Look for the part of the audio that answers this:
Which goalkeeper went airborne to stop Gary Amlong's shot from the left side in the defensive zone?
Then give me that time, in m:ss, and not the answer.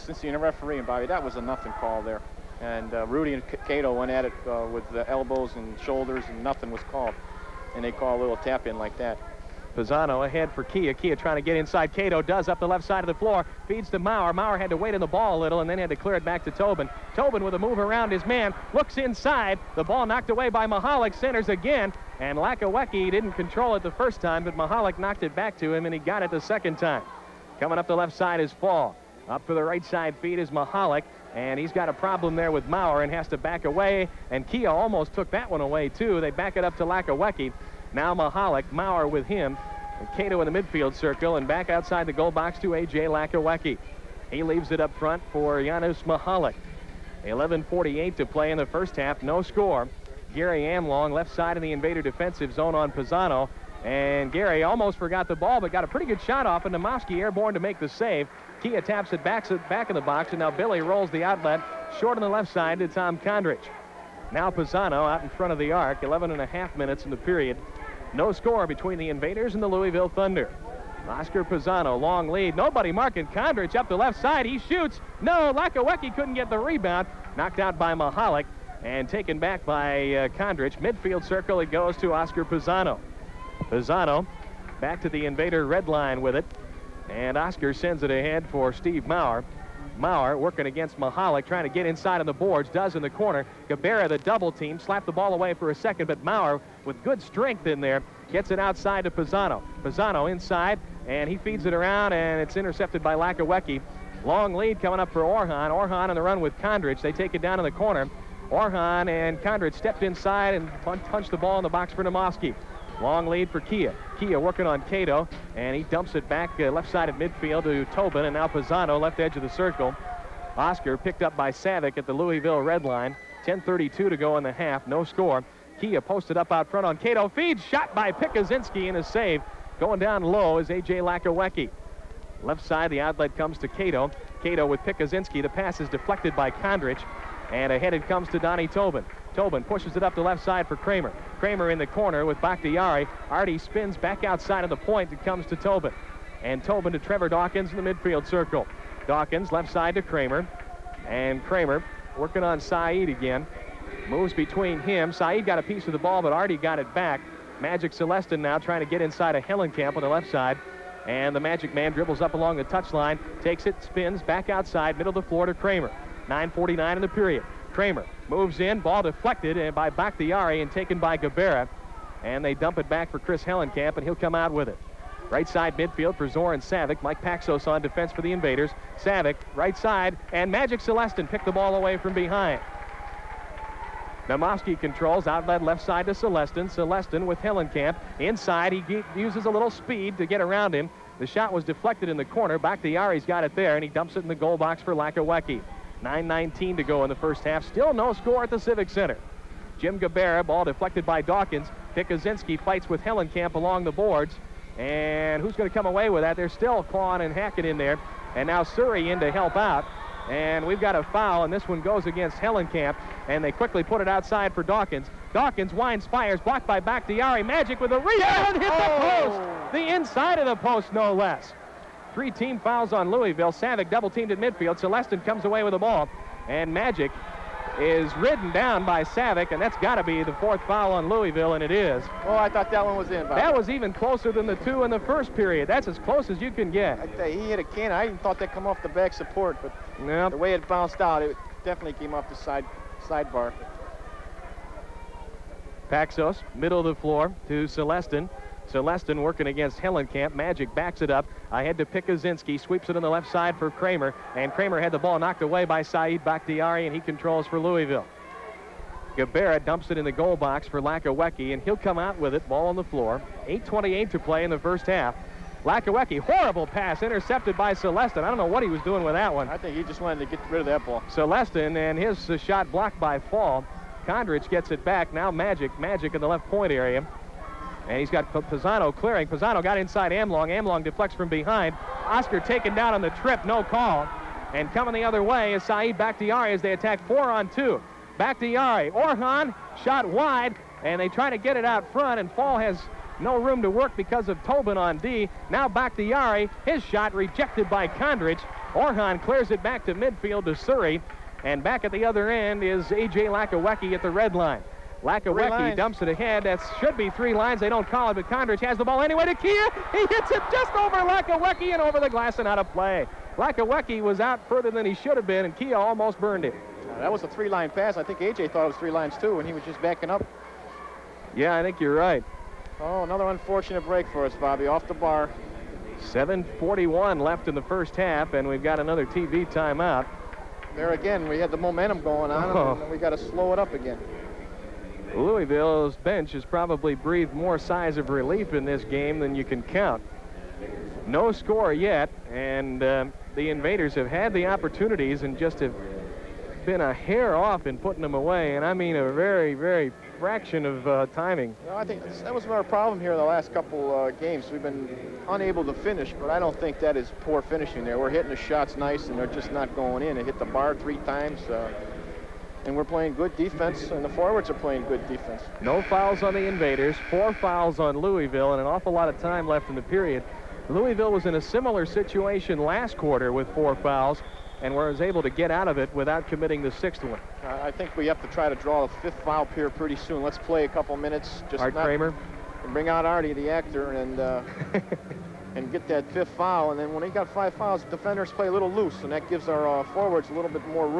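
0:56.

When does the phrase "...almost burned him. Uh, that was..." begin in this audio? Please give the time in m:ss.
5:15.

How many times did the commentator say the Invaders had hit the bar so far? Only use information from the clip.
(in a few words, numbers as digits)
3.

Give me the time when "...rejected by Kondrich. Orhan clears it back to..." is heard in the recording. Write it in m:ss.
4:57.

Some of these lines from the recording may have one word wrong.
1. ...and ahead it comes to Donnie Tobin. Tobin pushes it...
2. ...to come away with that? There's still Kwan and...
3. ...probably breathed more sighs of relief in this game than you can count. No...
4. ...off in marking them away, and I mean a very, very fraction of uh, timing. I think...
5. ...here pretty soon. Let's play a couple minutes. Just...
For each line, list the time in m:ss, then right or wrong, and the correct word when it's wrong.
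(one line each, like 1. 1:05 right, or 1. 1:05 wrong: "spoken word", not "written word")
1. 2:17 right
2. 3:25 right
3. 5:36 right
4. 5:47 wrong: "putting", not "marking"
5. 6:19 right.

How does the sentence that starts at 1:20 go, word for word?
Midfield circle, it goes to Oscar Pisano.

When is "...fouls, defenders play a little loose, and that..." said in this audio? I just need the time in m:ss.
6:27.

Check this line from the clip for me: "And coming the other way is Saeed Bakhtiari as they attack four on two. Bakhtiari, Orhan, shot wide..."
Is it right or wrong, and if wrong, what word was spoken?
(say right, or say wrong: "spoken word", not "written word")
right.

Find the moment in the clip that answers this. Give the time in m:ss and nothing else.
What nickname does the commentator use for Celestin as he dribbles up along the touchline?
2:41.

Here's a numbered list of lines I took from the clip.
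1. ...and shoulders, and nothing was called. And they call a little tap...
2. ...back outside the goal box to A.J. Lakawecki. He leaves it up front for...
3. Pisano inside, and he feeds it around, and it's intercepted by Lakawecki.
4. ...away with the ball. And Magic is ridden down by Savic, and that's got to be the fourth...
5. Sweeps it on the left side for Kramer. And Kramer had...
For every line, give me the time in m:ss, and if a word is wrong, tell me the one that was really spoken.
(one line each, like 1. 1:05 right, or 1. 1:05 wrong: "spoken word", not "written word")
1. 0:05 right
2. 0:41 right
3. 1:39 right
4. 3:45 right
5. 4:12 right.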